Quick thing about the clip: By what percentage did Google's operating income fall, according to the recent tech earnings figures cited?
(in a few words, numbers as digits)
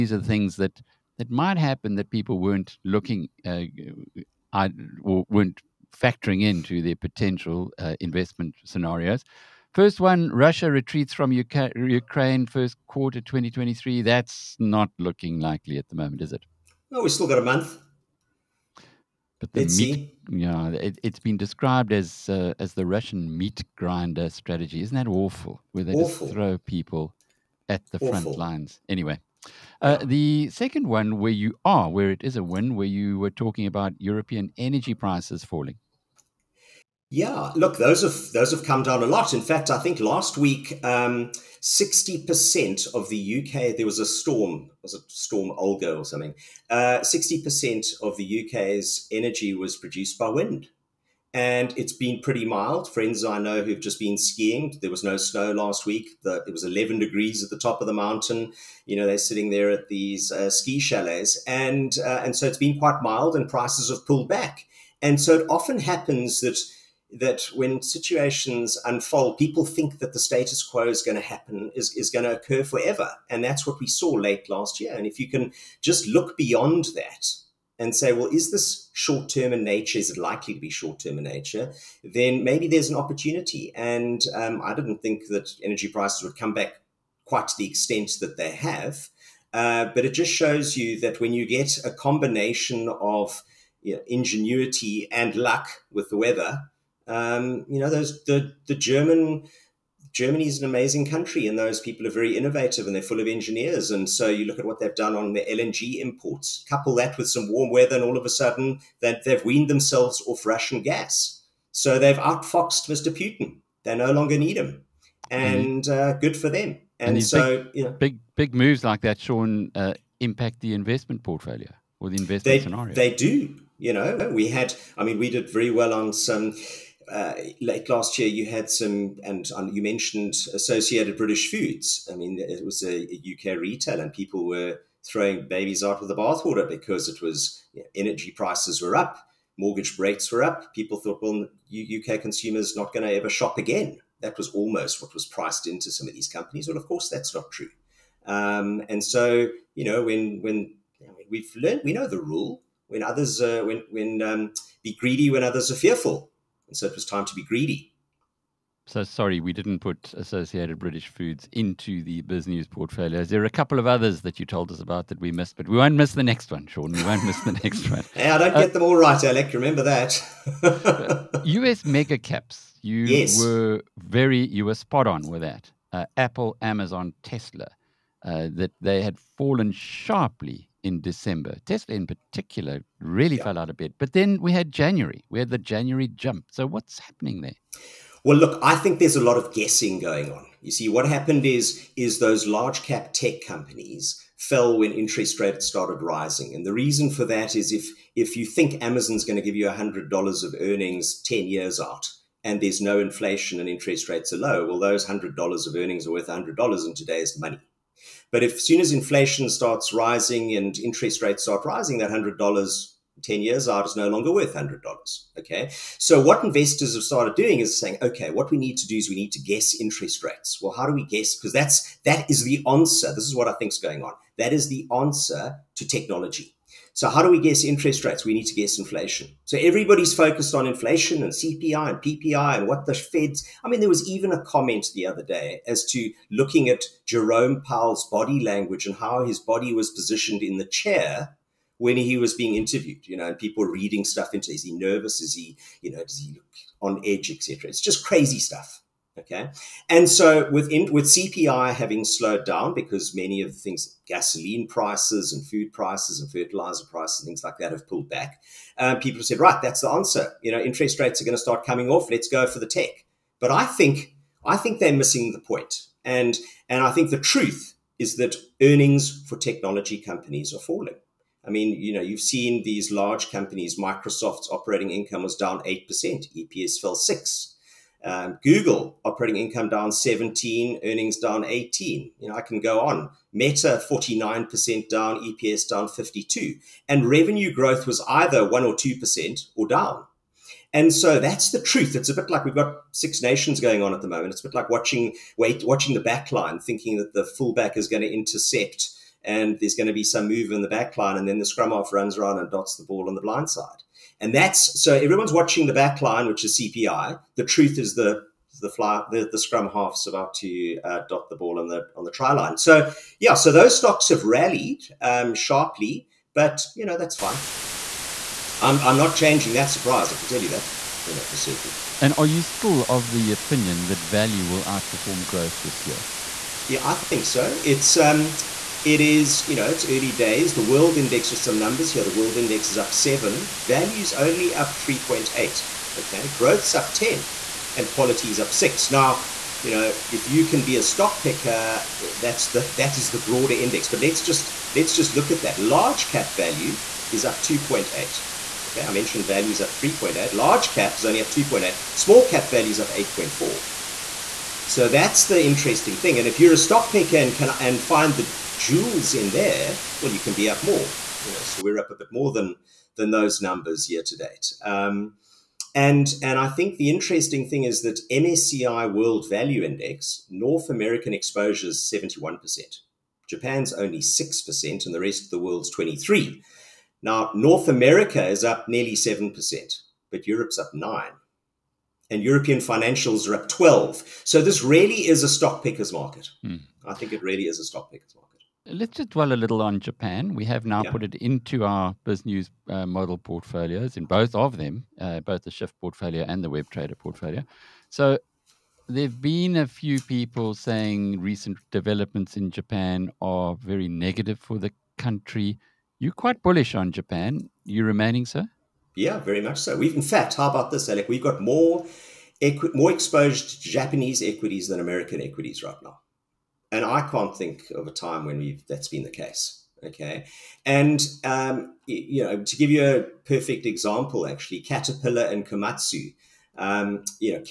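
17%.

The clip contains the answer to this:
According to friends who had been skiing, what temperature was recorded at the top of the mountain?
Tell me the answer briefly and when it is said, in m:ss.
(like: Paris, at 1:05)
11 degrees, at 0:56.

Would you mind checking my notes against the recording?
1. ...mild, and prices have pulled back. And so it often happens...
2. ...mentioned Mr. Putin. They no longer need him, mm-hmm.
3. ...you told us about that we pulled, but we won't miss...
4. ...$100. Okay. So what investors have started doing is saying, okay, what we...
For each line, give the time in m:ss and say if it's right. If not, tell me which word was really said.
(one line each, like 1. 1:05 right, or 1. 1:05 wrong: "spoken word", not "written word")
1. 1:03 right
2. 1:52 wrong: "outfoxed", not "mentioned"
3. 2:44 wrong: "missed", not "pulled"
4. 3:34 right.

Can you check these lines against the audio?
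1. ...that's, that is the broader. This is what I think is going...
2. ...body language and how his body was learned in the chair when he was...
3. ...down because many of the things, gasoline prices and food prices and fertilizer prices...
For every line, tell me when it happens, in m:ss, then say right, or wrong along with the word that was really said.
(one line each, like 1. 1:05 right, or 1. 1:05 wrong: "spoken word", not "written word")
1. 3:41 wrong: "answer", not "broader"
2. 3:58 wrong: "positioned", not "learned"
3. 4:12 right.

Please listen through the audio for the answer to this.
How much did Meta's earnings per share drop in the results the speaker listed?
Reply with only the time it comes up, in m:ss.
4:45.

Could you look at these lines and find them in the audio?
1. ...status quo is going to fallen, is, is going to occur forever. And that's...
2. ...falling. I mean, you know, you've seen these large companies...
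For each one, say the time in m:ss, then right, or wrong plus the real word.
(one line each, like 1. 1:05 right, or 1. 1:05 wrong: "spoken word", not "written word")
1. 1:10 wrong: "happen", not "fallen"
2. 4:30 right.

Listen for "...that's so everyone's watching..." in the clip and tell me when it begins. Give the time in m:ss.
5:04.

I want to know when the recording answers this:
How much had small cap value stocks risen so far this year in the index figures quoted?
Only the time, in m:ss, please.
5:52.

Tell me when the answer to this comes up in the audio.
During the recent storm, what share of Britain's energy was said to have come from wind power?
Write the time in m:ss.
0:47.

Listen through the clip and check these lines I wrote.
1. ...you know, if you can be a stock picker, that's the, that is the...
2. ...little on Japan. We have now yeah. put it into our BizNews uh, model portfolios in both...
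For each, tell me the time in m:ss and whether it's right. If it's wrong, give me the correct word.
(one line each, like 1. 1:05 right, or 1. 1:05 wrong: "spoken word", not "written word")
1. 5:39 right
2. 6:29 right.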